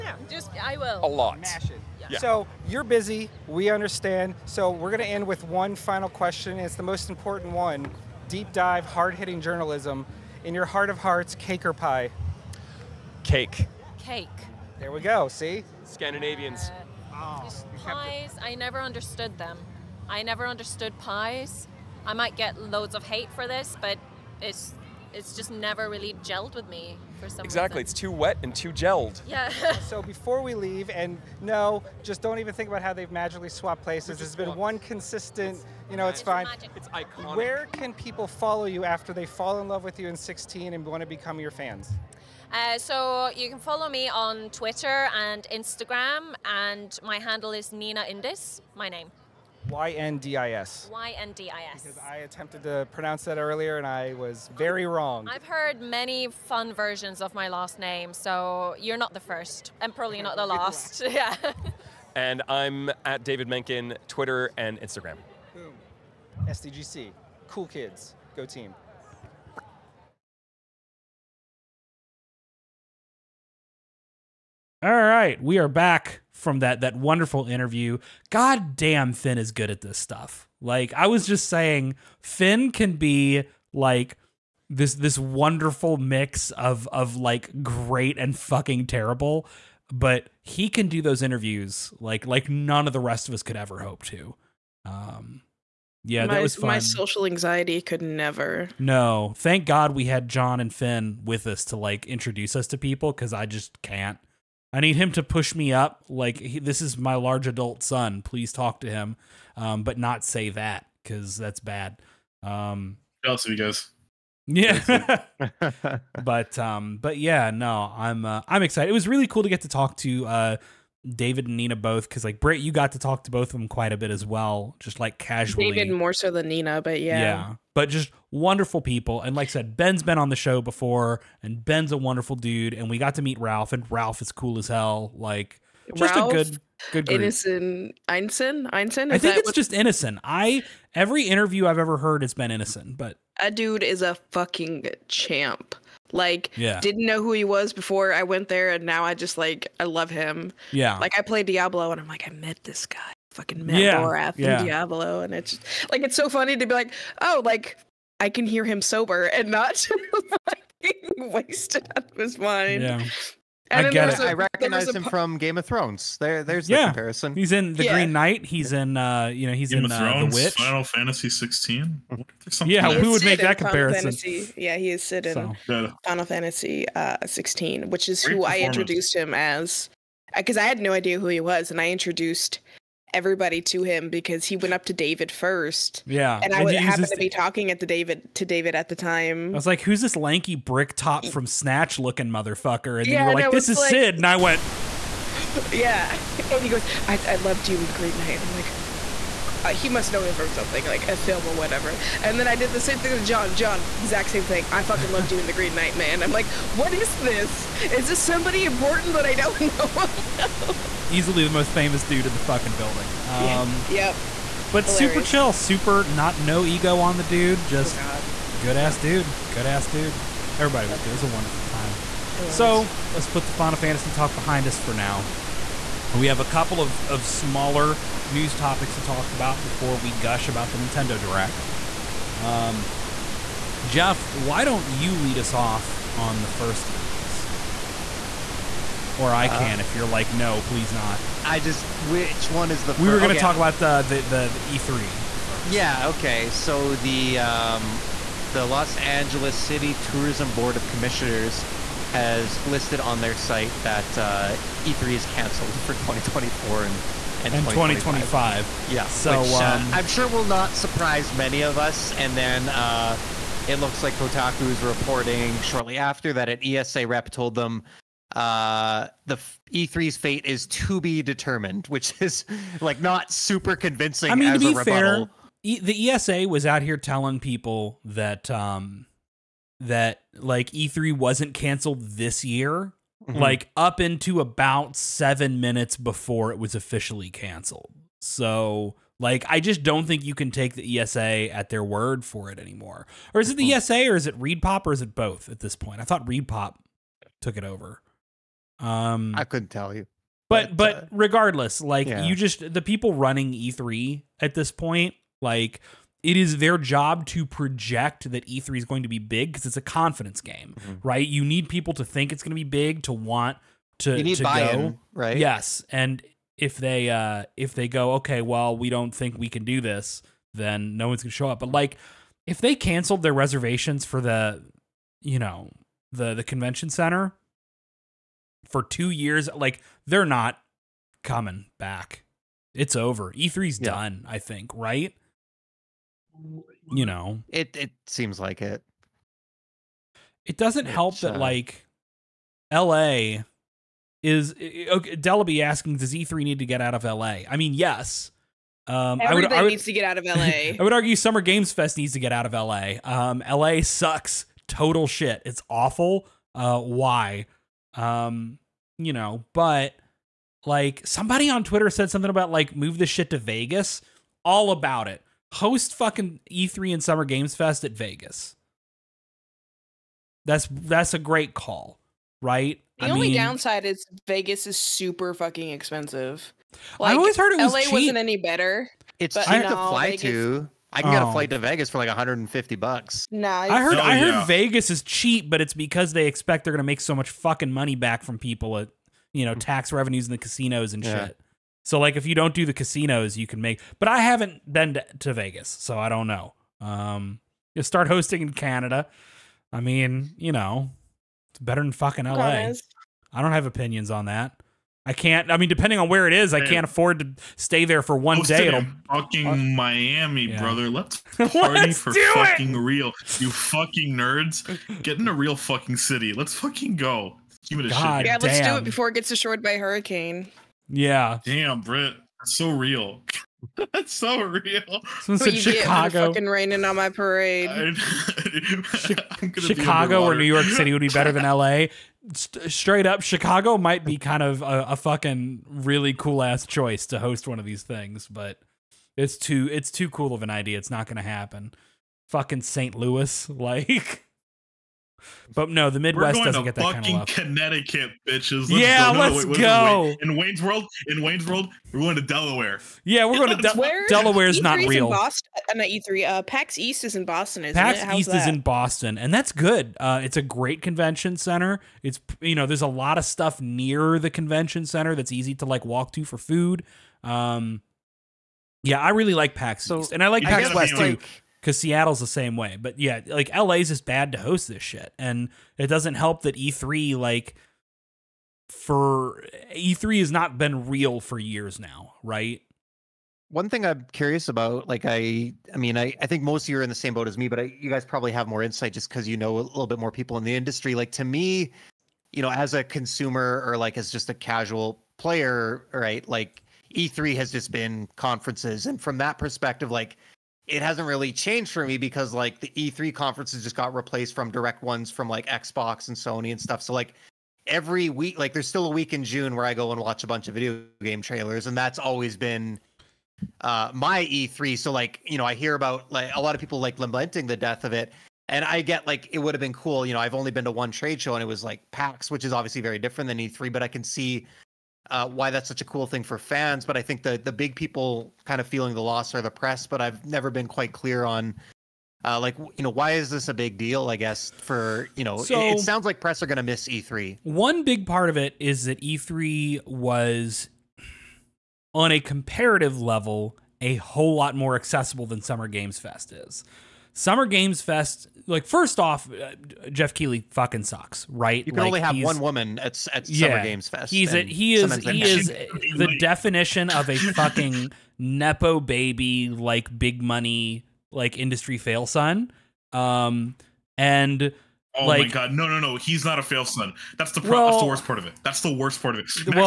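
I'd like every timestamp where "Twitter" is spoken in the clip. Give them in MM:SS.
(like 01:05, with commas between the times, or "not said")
00:44, 01:04, 06:01.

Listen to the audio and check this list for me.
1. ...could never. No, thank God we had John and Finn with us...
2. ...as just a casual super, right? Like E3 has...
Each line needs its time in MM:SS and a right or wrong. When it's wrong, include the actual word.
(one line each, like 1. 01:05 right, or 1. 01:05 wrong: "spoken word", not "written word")
1. 01:37 right
2. 08:13 wrong: "player", not "super".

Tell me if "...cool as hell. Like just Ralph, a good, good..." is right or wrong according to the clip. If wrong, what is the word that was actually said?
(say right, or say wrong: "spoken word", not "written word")
right.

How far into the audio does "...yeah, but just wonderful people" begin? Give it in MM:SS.
02:07.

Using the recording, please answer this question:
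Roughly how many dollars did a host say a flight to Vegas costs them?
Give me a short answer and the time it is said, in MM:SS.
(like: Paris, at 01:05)
150, at 06:22.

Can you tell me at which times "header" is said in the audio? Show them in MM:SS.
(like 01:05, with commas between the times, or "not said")
not said.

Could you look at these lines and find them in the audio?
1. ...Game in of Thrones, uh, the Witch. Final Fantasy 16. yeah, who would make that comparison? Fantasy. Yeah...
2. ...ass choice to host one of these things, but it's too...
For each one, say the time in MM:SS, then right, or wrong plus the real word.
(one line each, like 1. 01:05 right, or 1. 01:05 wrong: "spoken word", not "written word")
1. 02:49 right
2. 07:16 right.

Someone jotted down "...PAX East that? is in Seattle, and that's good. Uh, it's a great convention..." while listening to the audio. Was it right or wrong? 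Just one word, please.
wrong.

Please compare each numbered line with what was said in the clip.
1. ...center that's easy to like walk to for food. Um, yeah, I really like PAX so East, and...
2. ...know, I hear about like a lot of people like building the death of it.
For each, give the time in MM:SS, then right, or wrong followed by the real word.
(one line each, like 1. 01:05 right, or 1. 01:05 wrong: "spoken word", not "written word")
1. 07:44 right
2. 08:35 wrong: "lamenting", not "building".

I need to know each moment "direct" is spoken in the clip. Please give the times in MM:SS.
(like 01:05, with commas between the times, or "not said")
03:51, 08:24.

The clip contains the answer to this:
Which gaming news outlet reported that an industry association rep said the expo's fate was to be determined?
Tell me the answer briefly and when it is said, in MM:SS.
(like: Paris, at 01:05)
Kotaku, at 04:24.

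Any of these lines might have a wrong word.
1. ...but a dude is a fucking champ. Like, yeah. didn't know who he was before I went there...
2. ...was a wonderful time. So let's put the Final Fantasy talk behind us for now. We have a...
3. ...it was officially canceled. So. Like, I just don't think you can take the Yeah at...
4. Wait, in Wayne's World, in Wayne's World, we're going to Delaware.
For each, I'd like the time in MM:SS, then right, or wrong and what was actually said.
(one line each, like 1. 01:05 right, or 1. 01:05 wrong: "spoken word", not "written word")
1. 02:22 right
2. 03:41 right
3. 04:46 wrong: "ESA", not "Yeah"
4. 07:30 right.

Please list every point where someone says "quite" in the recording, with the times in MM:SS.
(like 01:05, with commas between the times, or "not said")
02:03, 08:50.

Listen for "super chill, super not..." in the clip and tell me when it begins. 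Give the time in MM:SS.
03:35.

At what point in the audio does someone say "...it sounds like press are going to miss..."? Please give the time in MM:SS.
08:55.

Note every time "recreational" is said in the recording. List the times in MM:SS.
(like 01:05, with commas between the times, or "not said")
not said.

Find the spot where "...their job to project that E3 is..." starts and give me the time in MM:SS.
05:06.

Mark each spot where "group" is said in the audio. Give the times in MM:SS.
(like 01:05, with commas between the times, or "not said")
02:17.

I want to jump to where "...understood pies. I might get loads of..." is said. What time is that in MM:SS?
00:20.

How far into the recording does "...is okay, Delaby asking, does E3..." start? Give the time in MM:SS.
05:44.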